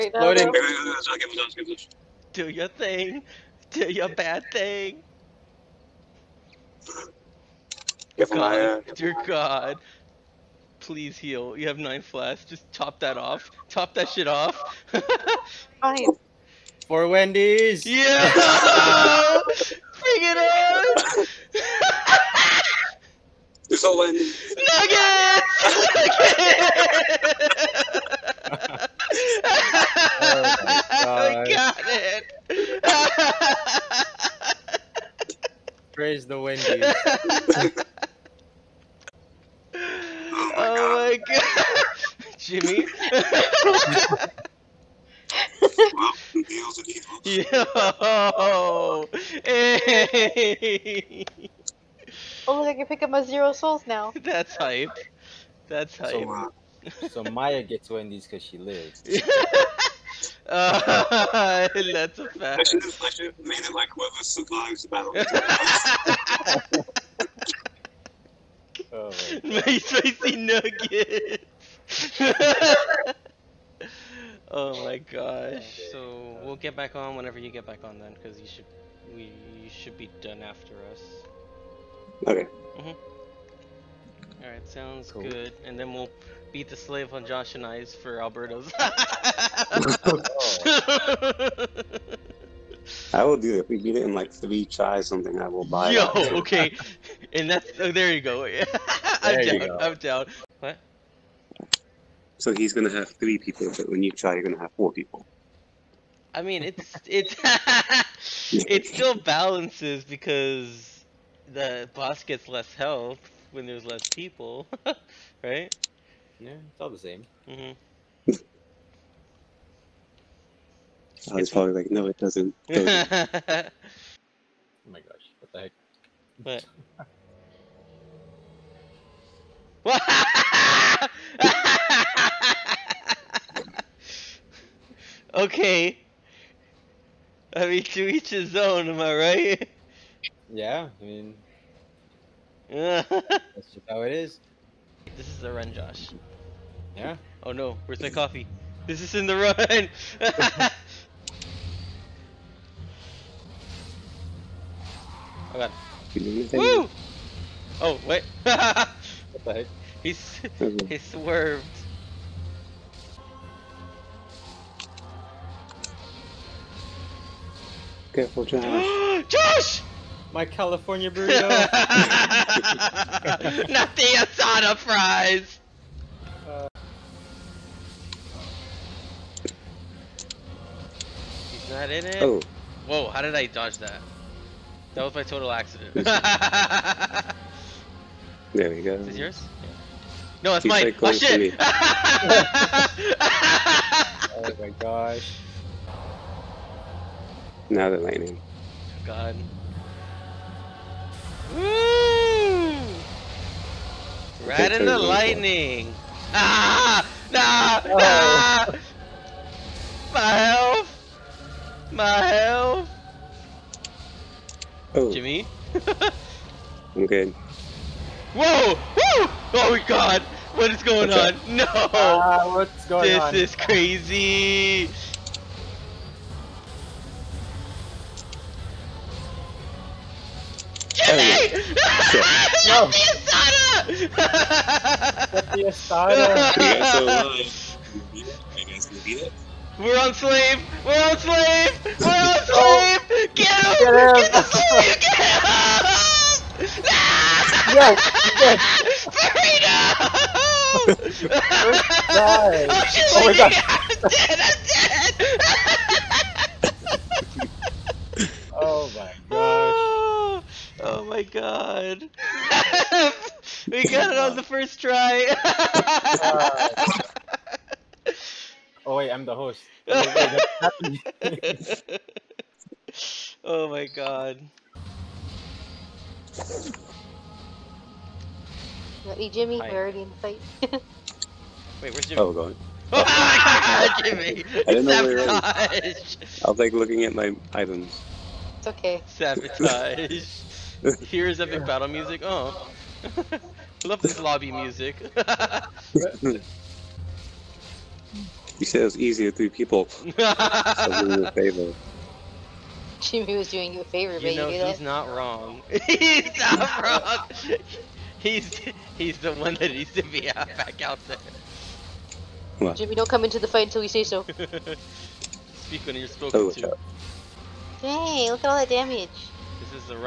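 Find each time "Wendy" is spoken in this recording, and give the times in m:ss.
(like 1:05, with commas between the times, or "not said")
0:17, 0:23, 0:36, 0:57.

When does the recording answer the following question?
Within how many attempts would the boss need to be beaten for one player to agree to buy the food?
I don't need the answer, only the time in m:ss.
1:34.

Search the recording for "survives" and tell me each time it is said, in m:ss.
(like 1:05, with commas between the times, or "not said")
1:04.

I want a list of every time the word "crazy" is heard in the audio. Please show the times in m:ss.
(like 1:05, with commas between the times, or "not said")
3:43.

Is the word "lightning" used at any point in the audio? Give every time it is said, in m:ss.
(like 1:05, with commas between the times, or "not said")
3:17, 3:24.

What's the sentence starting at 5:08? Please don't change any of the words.
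he's he's the one that needs to be out back out there.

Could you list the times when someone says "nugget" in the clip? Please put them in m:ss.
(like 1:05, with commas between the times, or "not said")
0:24, 1:10.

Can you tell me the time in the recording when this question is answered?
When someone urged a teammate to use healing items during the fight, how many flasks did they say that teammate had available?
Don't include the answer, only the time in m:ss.
0:11.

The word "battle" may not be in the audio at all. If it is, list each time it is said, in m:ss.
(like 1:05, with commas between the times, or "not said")
1:04, 4:51.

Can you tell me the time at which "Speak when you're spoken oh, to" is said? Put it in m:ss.
5:14.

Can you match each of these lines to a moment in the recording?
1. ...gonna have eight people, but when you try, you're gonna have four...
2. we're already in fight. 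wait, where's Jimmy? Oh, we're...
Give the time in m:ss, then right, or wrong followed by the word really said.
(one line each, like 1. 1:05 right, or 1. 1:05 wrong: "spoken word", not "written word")
1. 1:42 wrong: "three", not "eight"
2. 4:39 right.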